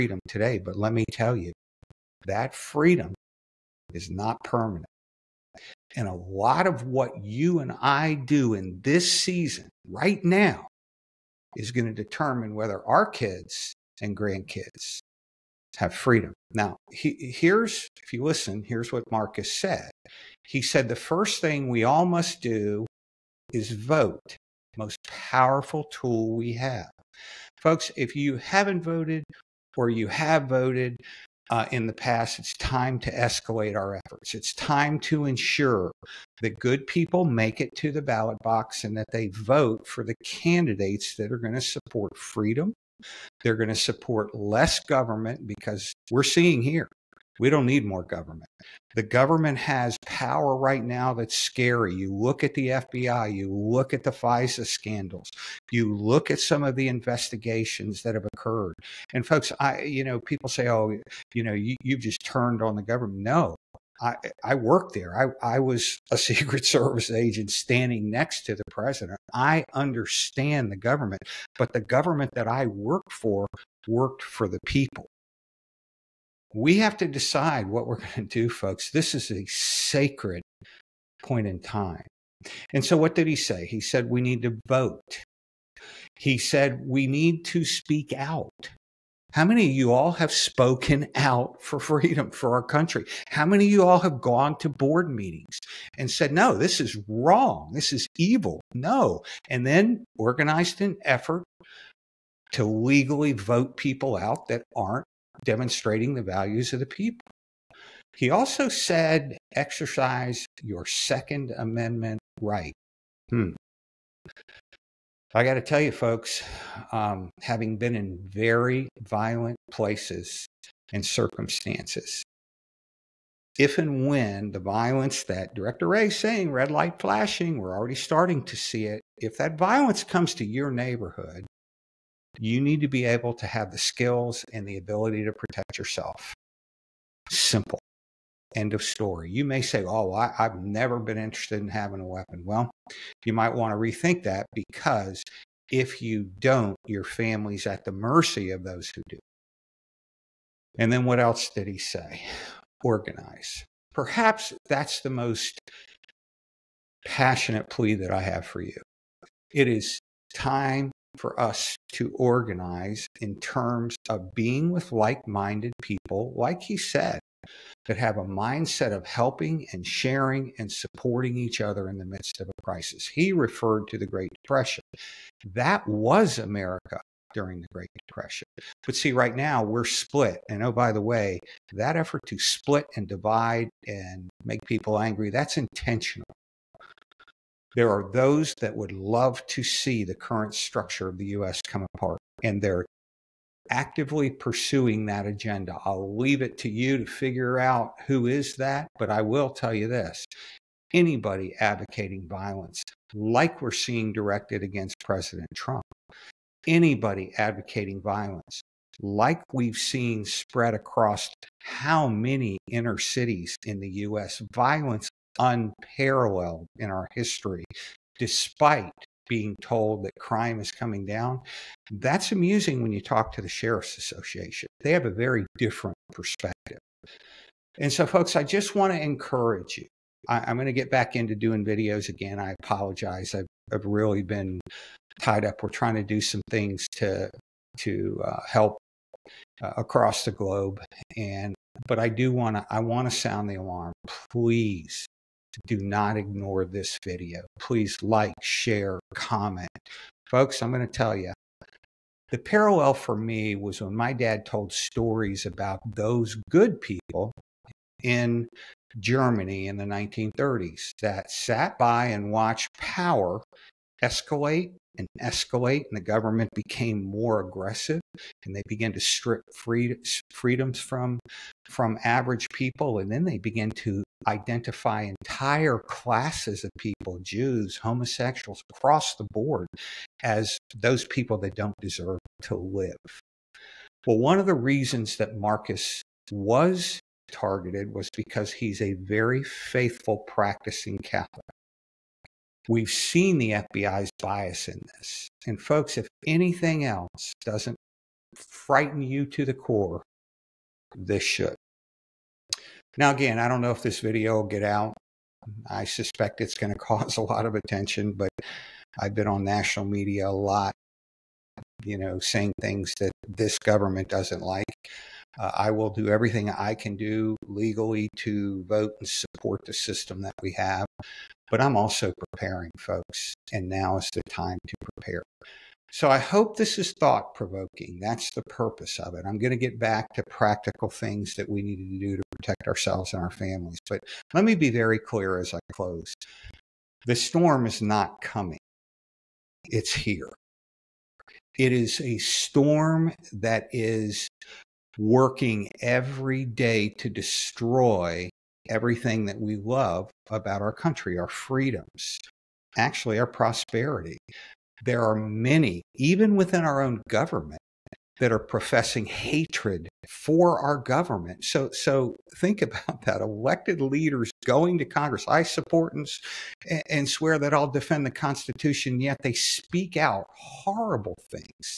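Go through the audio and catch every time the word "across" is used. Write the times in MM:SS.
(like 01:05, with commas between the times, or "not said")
03:30, 03:59, 04:38.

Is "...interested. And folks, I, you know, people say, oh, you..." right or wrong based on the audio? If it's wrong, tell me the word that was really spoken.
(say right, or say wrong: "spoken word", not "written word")
wrong: "occurred", not "interested".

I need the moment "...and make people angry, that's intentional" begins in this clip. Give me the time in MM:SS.
03:03.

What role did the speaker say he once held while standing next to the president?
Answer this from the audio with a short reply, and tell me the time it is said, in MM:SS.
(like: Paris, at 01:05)
Secret Service agent, at 01:06.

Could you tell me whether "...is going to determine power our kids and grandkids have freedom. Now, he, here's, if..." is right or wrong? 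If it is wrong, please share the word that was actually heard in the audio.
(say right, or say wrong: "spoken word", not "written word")
wrong: "whether", not "power".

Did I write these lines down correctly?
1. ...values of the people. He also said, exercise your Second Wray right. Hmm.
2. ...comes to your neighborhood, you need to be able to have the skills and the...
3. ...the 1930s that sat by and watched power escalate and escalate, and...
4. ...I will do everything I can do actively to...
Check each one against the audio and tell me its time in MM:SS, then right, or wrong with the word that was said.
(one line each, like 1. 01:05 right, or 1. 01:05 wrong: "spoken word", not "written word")
1. 01:46 wrong: "Amendment", not "Wray"
2. 02:10 right
3. 04:19 right
4. 05:15 wrong: "legally", not "actively".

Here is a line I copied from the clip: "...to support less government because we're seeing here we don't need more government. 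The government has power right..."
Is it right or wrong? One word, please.
right.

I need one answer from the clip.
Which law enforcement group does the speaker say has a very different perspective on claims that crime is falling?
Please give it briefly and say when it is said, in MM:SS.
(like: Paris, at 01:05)
Sheriff's Association, at 03:43.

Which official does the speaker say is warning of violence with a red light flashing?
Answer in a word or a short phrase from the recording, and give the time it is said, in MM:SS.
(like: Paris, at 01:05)
Director Wray, at 02:05.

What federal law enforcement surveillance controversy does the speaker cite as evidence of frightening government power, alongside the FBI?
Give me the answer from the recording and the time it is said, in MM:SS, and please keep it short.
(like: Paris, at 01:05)
FISA scandals, at 00:54.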